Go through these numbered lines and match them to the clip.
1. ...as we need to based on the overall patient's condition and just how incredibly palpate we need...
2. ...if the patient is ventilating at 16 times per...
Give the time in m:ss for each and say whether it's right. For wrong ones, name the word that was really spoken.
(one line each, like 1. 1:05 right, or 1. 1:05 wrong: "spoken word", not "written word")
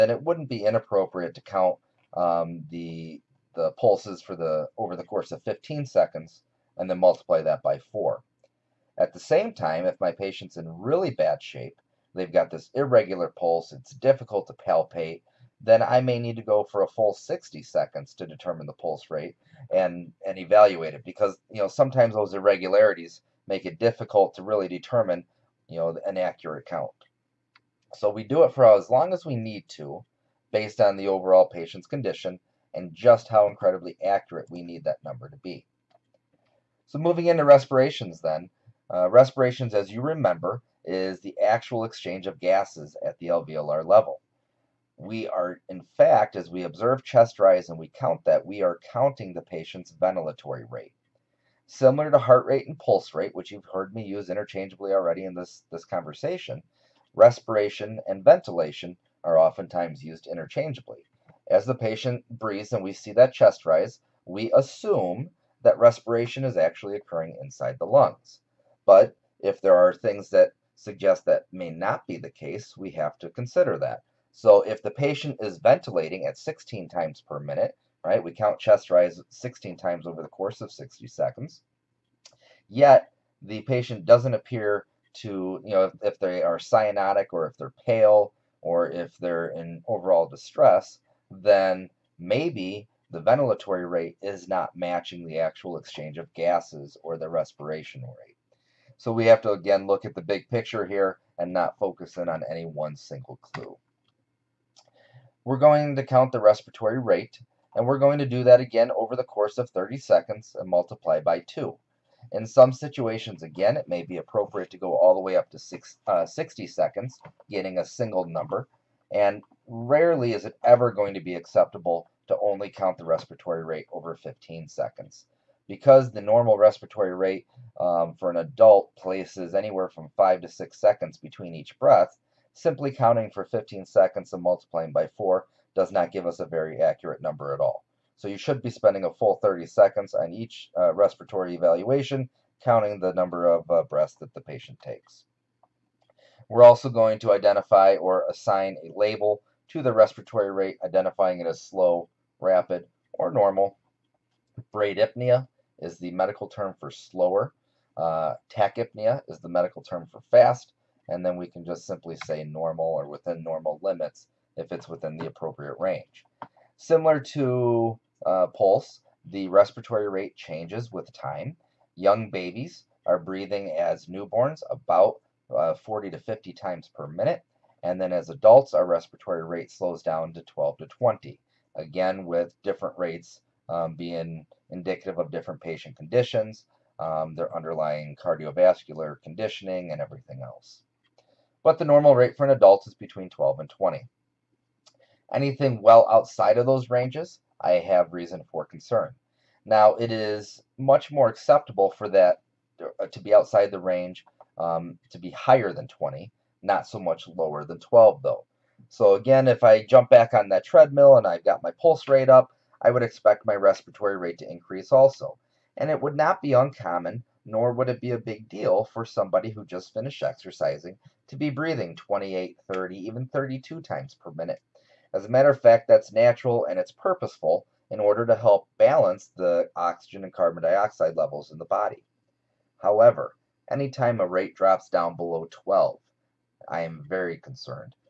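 1. 0:29 wrong: "accurate", not "palpate"
2. 1:14 right.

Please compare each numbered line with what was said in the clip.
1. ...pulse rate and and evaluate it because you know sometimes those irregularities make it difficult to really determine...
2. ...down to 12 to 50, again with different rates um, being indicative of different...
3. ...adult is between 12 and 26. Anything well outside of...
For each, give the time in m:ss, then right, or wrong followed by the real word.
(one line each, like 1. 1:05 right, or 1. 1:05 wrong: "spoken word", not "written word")
1. 0:18 right
2. 3:00 wrong: "20", not "50"
3. 3:12 wrong: "20", not "26".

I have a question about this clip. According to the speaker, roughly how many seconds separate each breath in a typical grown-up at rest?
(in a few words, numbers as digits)
5 to 6 seconds.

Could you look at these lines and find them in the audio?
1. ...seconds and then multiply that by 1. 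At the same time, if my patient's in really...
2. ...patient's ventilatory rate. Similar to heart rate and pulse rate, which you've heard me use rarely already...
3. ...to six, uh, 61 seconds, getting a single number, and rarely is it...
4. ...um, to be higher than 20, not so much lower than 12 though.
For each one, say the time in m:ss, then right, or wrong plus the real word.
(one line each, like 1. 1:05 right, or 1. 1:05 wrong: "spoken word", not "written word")
1. 0:05 wrong: "4", not "1"
2. 0:49 wrong: "interchangeably", not "rarely"
3. 1:55 wrong: "60", not "61"
4. 3:24 right.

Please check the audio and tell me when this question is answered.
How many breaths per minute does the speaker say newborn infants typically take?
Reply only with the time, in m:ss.
2:55.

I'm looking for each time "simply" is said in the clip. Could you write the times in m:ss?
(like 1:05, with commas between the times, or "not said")
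2:12, 2:41.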